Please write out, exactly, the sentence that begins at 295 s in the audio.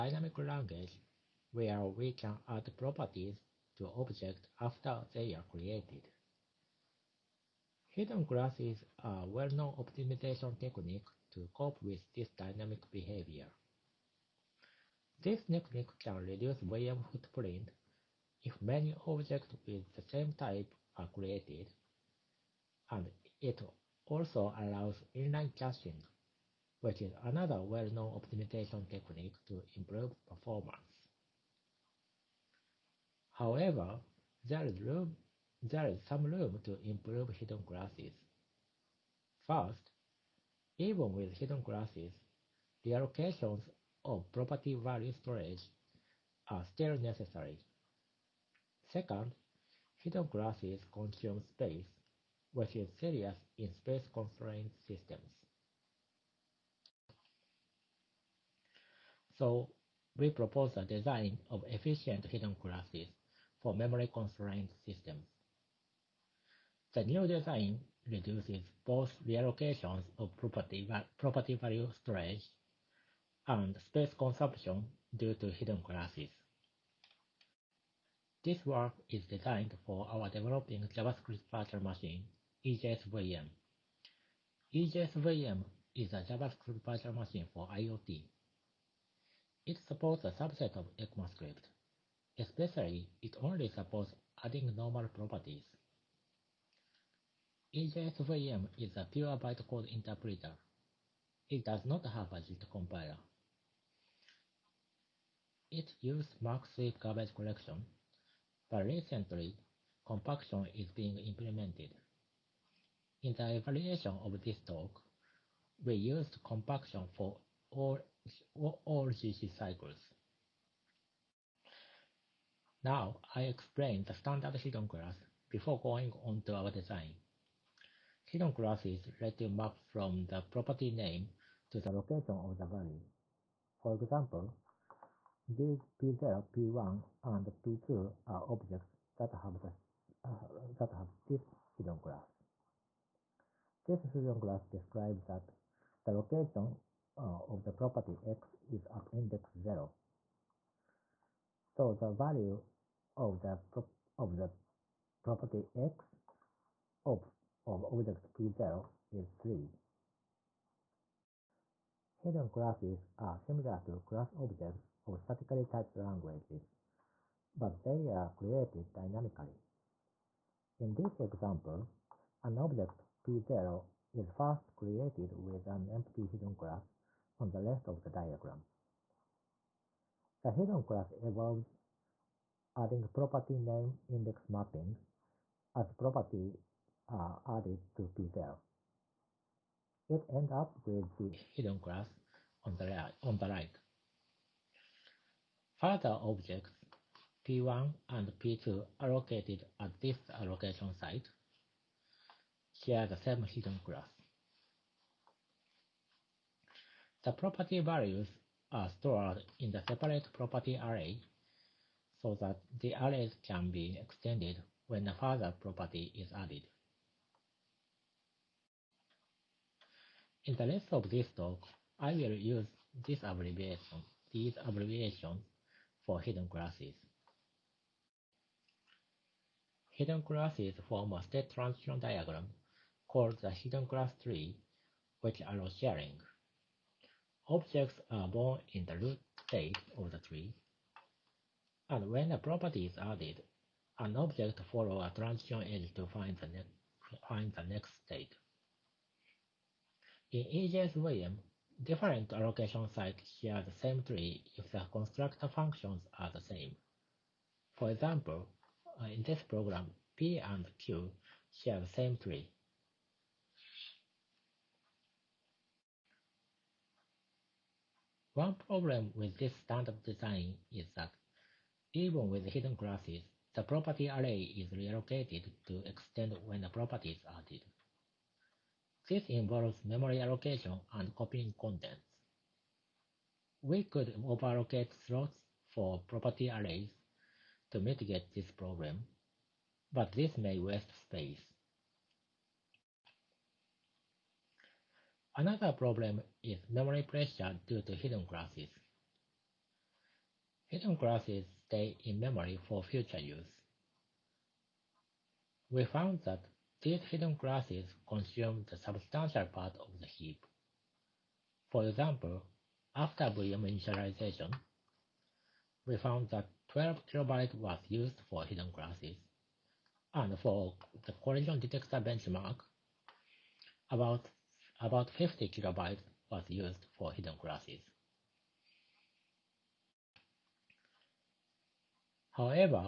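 Another problem is memory pressure due to hidden classes.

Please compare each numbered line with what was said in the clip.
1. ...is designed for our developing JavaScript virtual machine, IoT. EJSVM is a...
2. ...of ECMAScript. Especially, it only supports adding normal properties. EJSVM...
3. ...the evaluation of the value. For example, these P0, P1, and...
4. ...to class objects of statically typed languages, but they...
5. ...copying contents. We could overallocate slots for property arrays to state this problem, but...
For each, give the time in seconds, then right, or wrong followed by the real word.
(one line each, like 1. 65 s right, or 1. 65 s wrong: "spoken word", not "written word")
1. 79 s wrong: "EJSVM", not "IoT"
2. 90 s right
3. 131 s wrong: "location", not "evaluation"
4. 163 s right
5. 281 s wrong: "mitigate", not "state".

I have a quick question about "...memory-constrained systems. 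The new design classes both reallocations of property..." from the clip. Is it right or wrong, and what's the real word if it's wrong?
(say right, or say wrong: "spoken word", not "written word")
wrong: "reduces", not "classes".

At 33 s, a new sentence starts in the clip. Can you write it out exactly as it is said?
However, there is, room, there is some room to improve hidden classes.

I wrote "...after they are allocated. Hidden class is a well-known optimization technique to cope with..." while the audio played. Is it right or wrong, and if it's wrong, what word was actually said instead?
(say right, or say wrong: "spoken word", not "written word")
wrong: "created", not "allocated".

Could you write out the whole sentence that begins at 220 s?
In the rest of this talk, I will use this abbreviation, these abbreviations for hidden classes.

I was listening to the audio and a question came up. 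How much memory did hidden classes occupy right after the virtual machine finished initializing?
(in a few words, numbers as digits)
12 kilobytes.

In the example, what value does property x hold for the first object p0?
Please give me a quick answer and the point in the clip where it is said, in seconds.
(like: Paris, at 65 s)
3, at 159 s.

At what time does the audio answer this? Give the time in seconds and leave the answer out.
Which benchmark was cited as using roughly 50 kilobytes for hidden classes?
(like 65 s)
321 s.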